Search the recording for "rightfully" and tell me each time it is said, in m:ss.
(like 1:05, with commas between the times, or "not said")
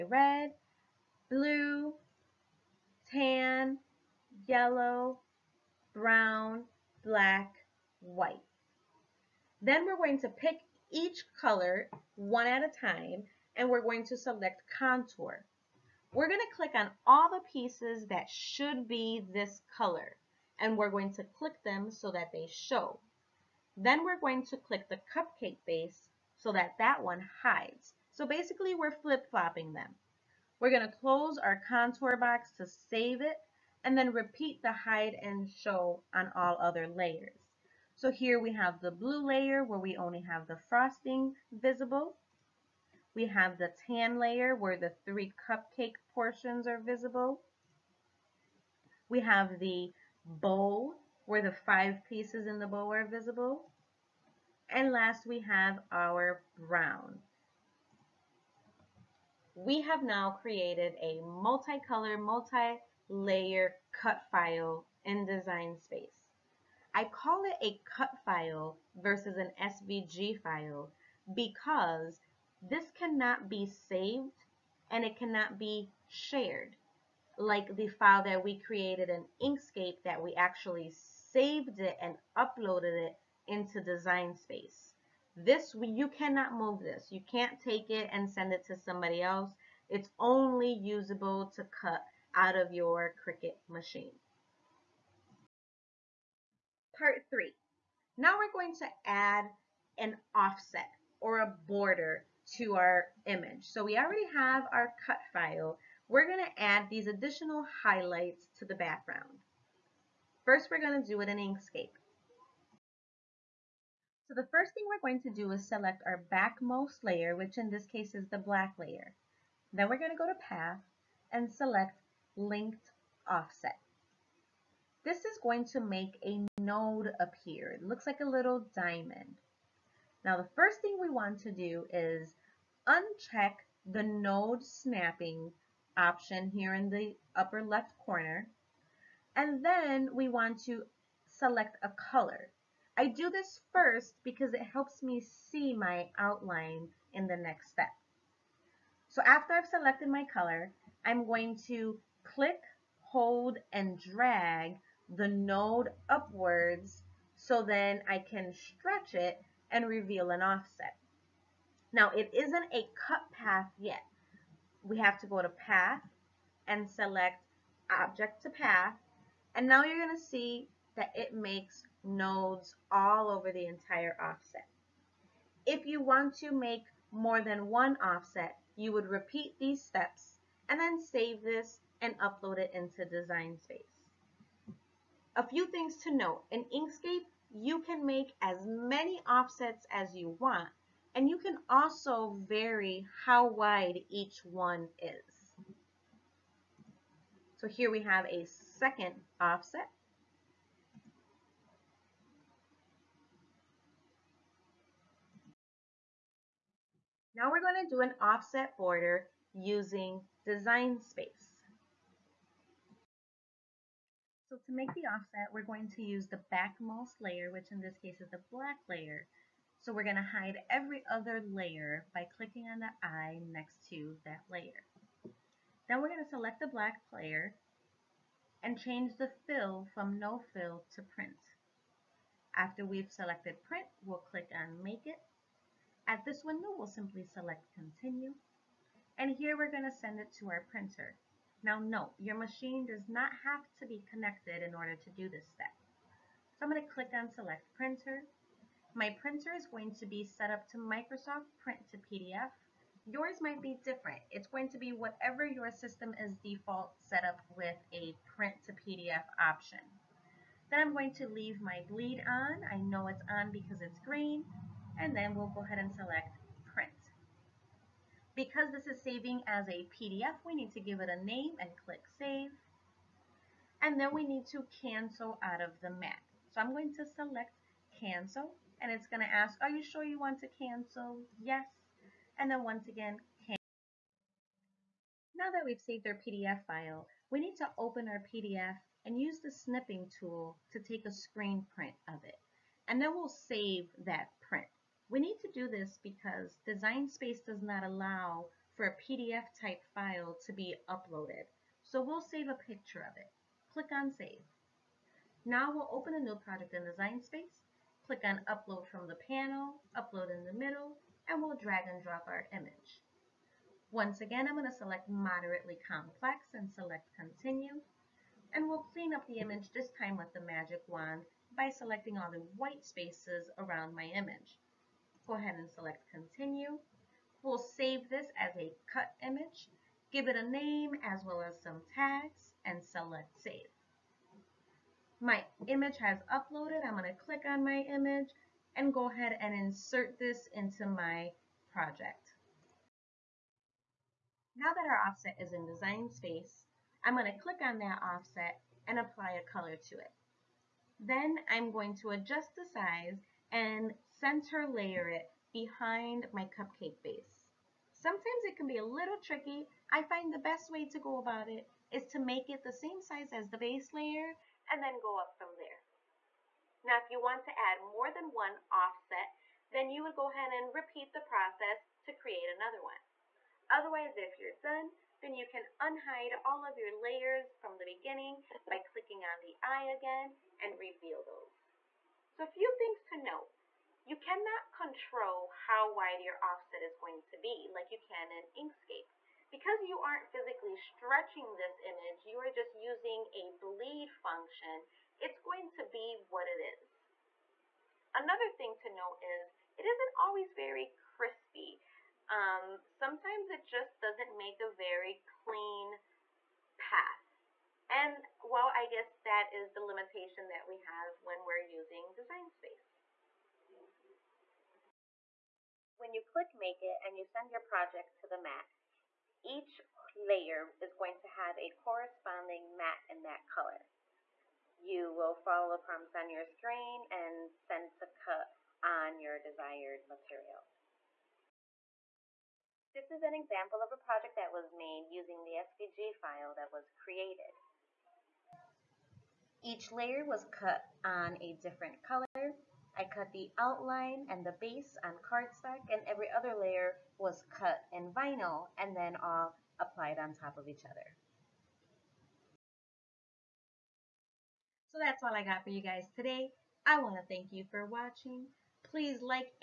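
not said.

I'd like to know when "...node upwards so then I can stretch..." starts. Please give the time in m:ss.
2:35.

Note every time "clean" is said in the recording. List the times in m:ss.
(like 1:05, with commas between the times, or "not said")
5:18, 6:45.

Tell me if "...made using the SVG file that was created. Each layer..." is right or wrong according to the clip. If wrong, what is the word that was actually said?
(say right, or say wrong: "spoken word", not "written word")
right.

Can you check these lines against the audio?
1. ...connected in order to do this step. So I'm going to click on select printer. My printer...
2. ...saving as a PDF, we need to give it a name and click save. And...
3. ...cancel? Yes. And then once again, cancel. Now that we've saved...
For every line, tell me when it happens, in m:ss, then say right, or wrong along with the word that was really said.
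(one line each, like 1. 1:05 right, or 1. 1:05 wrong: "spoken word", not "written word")
1. 4:04 right
2. 4:29 right
3. 4:40 right.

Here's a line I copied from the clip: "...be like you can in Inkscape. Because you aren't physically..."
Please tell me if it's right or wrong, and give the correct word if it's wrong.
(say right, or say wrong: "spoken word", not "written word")
right.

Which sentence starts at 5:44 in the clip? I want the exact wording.
Now that our offset is in design space, I'm going to click on that offset and apply a color to it.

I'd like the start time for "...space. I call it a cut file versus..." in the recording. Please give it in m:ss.
1:05.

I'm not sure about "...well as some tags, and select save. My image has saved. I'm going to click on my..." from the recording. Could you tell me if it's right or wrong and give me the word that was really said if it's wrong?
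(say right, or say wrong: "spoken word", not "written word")
wrong: "uploaded", not "saved".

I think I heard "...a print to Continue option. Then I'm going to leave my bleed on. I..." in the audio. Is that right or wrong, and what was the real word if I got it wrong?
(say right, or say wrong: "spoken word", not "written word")
wrong: "PDF", not "Continue".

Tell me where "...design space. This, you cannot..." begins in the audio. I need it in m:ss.
1:23.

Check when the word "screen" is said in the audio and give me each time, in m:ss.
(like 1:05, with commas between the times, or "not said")
4:51, 7:06.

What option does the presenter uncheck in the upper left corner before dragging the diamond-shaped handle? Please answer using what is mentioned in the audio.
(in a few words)
node snapping.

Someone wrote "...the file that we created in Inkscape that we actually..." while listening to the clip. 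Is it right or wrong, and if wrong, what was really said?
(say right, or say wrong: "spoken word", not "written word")
right.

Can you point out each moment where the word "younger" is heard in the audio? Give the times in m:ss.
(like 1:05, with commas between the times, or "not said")
not said.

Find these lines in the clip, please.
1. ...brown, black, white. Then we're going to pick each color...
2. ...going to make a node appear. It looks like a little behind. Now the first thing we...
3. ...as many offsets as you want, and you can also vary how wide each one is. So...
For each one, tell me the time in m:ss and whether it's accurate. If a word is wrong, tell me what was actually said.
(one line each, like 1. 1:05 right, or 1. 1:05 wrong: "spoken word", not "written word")
1. 0:05 right
2. 2:05 wrong: "diamond", not "behind"
3. 3:08 right.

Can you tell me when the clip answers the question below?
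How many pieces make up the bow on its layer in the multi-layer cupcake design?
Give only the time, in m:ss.
0:51.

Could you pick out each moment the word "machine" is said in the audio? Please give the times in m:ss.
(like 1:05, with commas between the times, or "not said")
1:33, 4:02.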